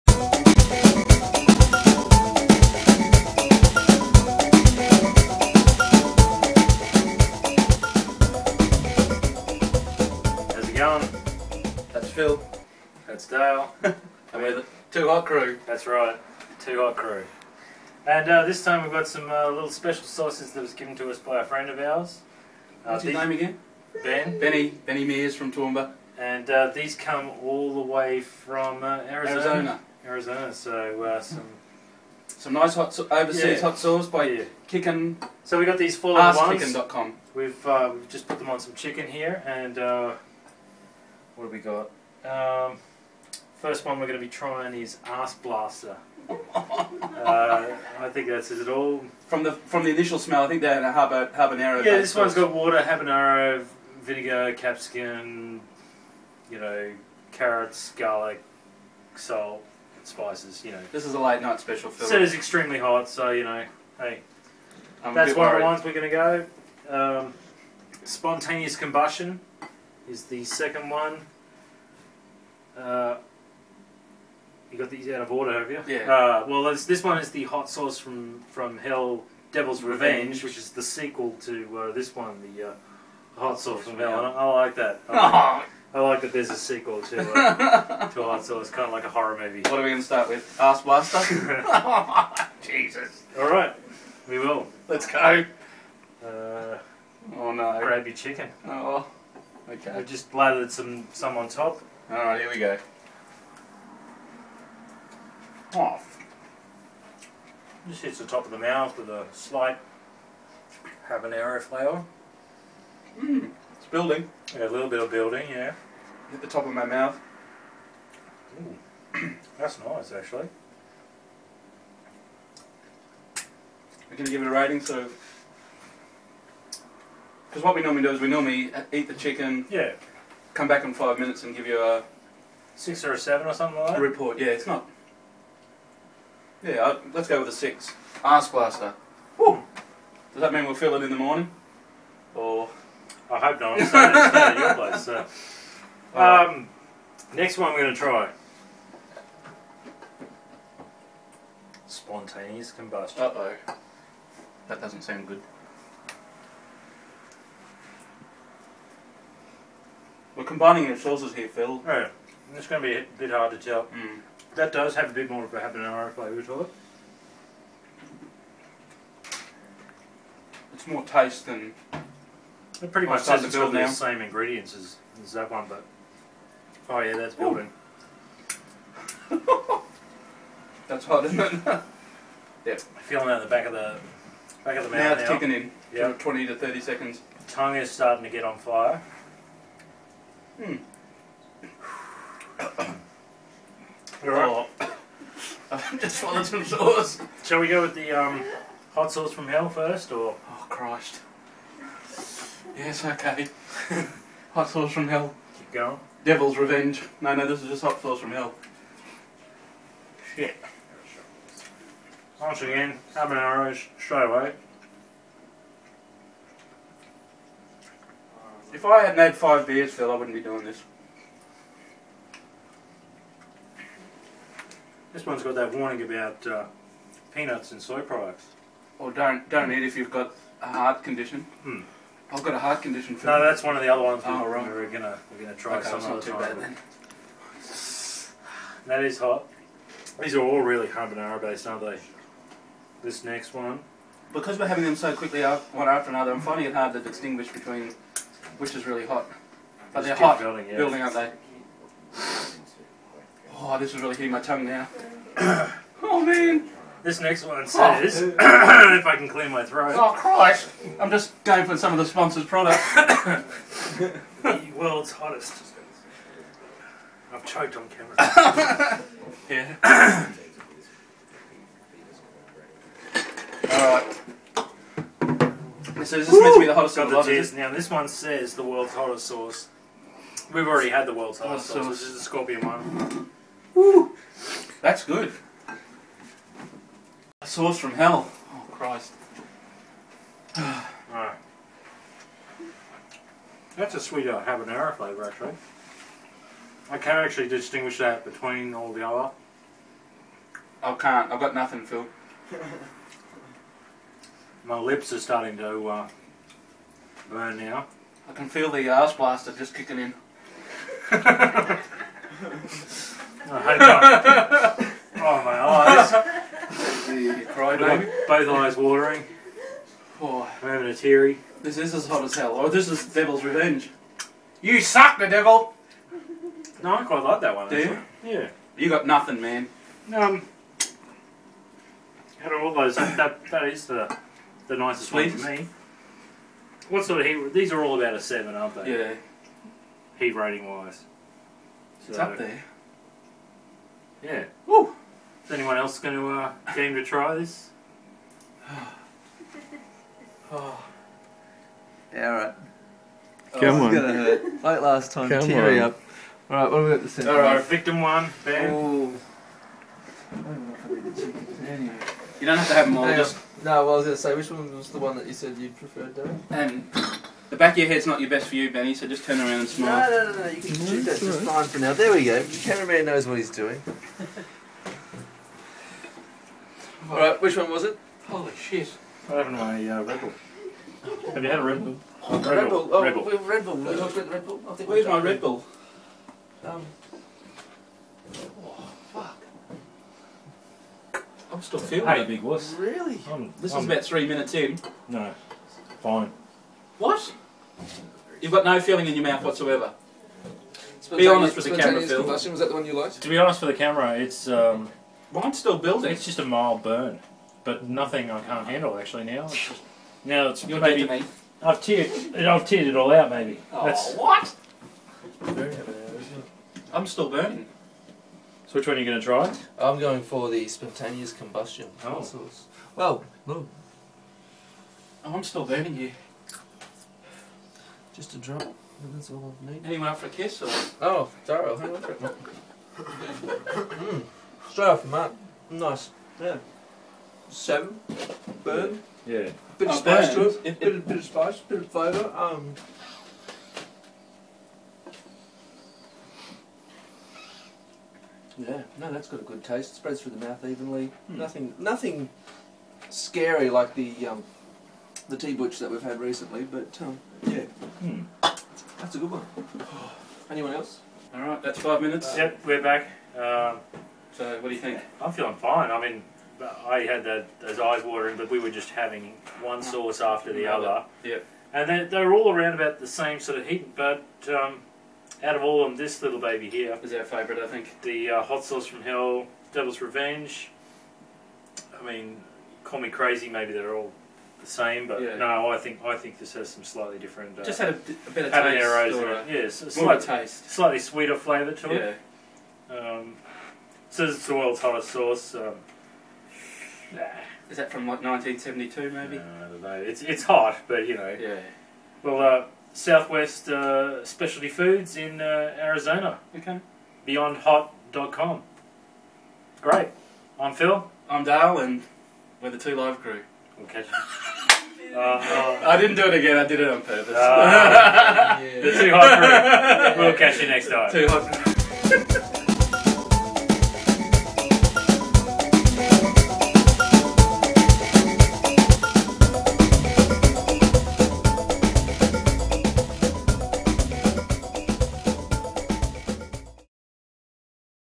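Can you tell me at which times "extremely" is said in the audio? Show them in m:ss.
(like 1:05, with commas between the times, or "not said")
1:02.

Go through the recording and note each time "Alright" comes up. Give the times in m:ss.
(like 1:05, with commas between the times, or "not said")
1:42, 4:50.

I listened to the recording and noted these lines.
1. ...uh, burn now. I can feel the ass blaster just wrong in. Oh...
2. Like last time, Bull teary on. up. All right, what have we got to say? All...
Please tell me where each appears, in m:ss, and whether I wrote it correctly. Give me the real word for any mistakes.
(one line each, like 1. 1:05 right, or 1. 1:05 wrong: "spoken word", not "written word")
1. 5:05 wrong: "kicking", not "wrong"
2. 5:54 wrong: "Come", not "Bull".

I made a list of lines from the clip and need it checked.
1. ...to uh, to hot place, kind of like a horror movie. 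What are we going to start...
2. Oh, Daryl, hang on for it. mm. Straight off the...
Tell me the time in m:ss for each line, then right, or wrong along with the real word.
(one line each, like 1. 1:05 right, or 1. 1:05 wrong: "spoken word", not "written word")
1. 1:27 wrong: "sauce", not "place"
2. 7:11 right.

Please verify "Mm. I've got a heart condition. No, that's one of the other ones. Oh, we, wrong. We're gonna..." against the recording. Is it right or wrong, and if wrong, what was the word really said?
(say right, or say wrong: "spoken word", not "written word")
right.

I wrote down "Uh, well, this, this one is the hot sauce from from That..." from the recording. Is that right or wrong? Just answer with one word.
wrong.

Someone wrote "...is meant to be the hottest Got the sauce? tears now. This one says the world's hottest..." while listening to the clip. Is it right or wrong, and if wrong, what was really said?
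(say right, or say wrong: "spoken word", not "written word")
right.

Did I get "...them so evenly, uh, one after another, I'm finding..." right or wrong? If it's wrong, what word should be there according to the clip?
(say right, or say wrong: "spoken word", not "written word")
wrong: "quickly", not "evenly".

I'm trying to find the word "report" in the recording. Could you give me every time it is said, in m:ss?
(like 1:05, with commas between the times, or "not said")
2:14.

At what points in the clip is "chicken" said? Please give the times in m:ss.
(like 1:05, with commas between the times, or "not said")
0:38, 1:38, 2:09, 6:01.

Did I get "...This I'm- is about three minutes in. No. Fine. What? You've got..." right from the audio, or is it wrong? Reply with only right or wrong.
right.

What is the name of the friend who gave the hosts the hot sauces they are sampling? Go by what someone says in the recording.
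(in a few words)
Benny Mears.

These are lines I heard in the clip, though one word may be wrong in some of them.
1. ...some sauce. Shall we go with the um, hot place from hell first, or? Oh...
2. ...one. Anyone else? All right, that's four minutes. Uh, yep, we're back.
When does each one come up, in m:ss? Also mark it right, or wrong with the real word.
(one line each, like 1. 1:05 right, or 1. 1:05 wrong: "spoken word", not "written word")
1. 3:16 wrong: "sauce", not "place"
2. 7:39 wrong: "five", not "four".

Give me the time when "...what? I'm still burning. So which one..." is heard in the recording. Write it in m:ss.
6:54.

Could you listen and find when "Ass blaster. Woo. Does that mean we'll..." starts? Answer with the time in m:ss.
2:18.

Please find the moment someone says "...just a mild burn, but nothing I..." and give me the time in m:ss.
6:46.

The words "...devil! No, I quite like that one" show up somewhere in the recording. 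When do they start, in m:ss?
5:25.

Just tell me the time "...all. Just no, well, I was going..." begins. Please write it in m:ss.
6:02.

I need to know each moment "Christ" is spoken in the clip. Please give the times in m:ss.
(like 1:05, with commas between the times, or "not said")
3:20, 4:20, 4:48.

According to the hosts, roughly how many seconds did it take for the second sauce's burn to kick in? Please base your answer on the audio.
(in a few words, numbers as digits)
20 to 30 seconds.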